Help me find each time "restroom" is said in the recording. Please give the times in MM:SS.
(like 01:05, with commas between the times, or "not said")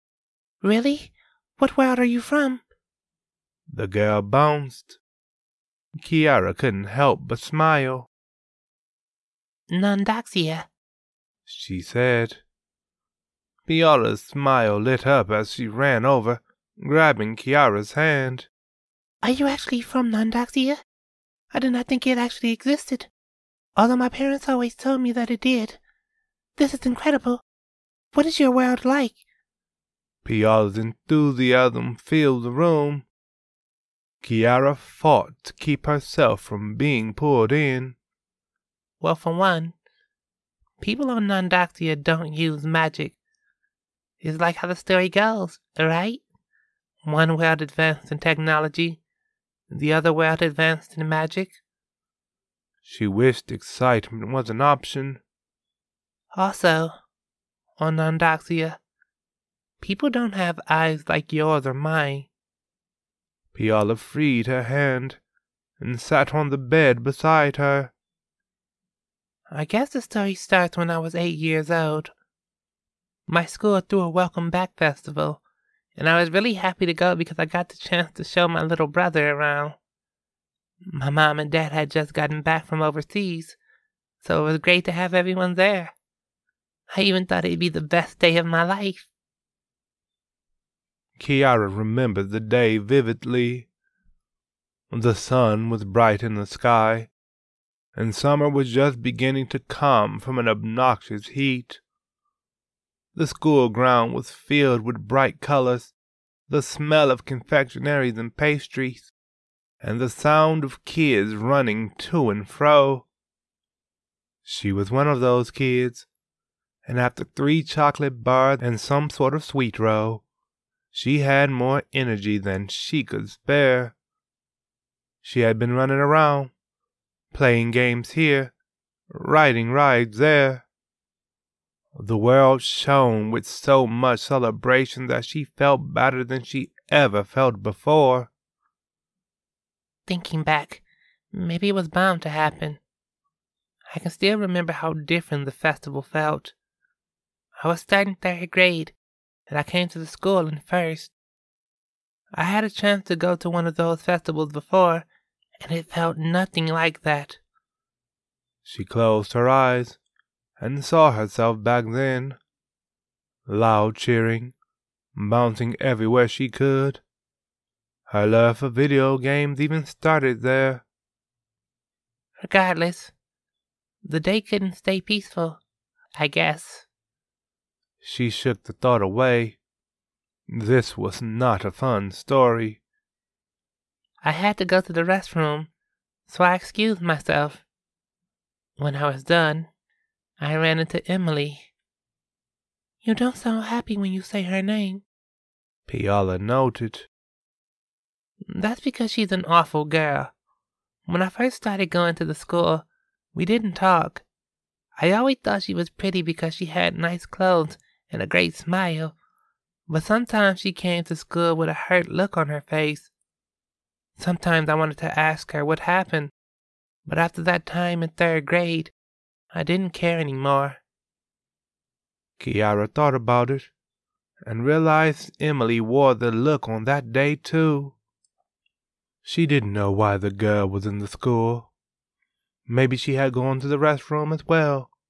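03:05, 03:53.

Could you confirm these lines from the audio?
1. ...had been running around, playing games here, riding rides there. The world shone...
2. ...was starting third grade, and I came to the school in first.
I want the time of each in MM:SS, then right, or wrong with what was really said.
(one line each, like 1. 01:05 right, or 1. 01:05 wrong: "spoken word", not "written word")
1. 02:05 right
2. 02:27 right.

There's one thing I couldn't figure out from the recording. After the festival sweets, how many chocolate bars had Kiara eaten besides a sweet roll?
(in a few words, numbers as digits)
3.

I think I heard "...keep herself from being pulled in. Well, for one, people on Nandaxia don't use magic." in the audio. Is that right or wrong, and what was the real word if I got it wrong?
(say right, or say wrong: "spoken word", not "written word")
right.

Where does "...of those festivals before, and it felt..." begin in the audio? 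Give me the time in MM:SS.
02:33.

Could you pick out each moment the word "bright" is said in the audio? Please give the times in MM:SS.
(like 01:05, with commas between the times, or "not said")
01:35, 01:45.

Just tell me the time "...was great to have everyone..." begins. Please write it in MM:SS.
01:24.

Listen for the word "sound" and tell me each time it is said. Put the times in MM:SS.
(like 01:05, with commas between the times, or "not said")
01:50, 03:13.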